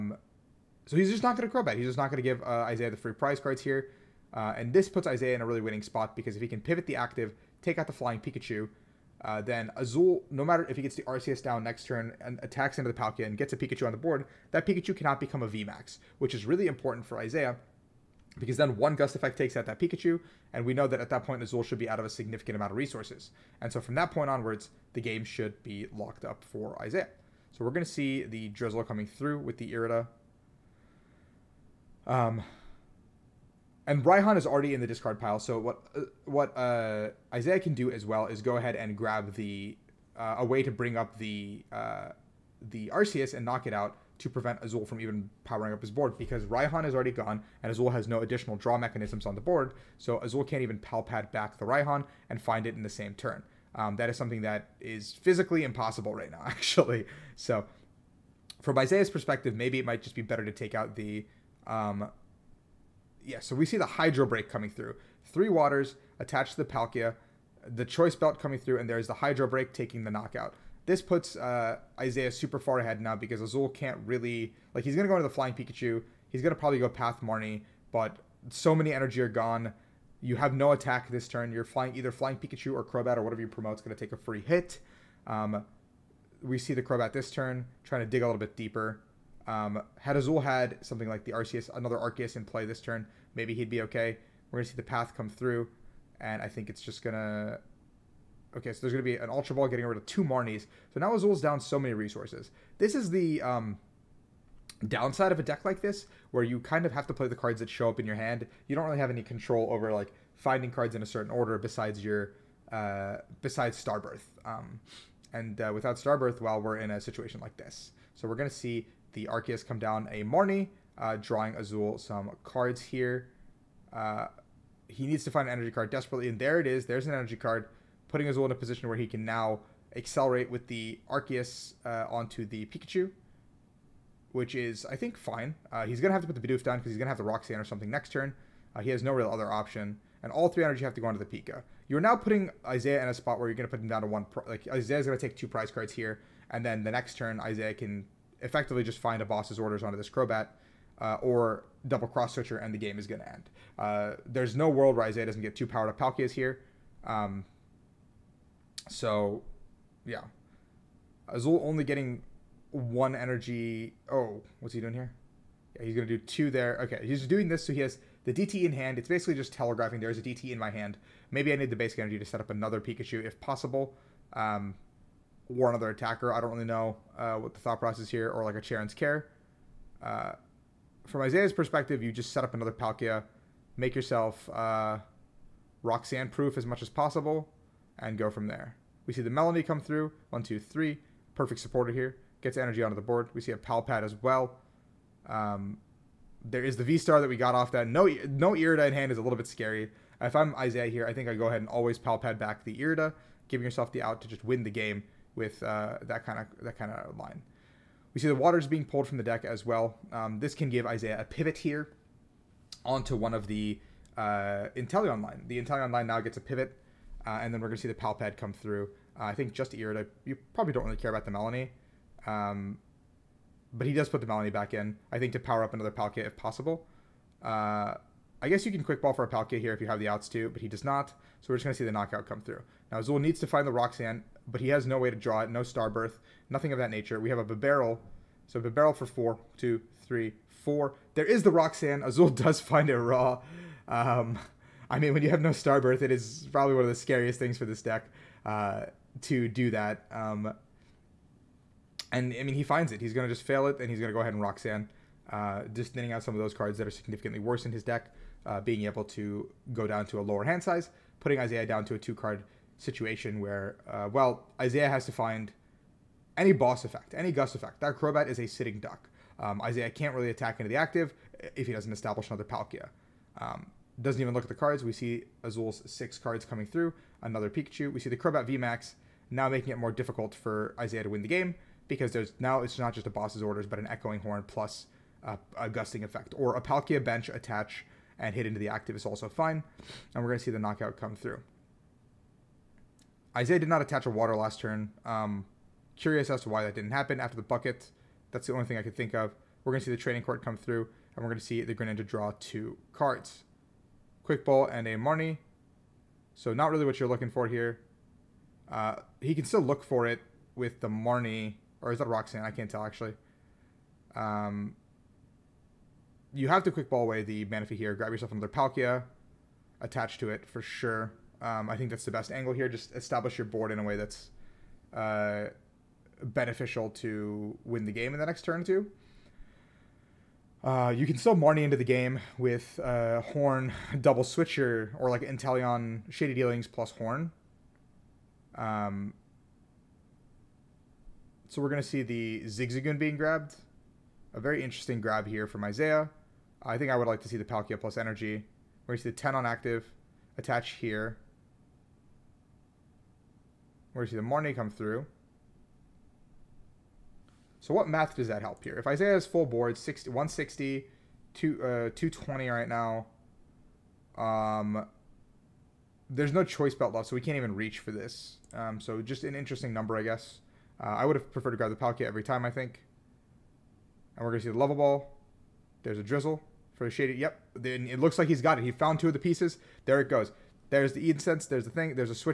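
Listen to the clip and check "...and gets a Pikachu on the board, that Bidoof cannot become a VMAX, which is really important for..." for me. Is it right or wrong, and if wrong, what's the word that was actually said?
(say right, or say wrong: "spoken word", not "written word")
wrong: "Pikachu", not "Bidoof".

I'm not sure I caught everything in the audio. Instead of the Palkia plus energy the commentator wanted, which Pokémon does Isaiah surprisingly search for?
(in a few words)
Zigzagoon.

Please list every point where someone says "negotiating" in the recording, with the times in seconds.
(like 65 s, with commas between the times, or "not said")
not said.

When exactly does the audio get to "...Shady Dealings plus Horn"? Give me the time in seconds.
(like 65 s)
336 s.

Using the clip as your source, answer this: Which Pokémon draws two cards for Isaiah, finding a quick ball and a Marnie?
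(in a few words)
Greninja.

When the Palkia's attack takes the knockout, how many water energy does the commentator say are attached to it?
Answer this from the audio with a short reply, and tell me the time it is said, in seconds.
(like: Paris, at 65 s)
3, at 65 s.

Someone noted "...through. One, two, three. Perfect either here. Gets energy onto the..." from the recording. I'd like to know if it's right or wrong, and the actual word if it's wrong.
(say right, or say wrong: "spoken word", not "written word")
wrong: "supporter", not "either".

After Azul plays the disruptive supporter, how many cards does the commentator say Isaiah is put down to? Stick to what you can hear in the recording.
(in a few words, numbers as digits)
2.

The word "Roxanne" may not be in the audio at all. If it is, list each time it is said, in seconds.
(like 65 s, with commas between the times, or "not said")
137 s, 185 s, 233 s, 241 s, 254 s, 312 s.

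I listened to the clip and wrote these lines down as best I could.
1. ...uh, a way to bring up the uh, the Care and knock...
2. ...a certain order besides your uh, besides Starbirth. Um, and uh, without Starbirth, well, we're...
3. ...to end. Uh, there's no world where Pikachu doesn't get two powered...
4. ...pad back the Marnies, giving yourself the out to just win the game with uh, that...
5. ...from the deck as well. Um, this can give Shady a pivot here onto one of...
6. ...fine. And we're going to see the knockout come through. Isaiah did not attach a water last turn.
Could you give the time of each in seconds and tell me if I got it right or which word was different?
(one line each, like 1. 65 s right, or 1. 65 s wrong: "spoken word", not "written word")
1. 40 s wrong: "Arceus", not "Care"
2. 111 s right
3. 153 s wrong: "Isaiah", not "Pikachu"
4. 202 s wrong: "Irida", not "Marnies"
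5. 209 s wrong: "Isaiah", not "Shady"
6. 289 s right.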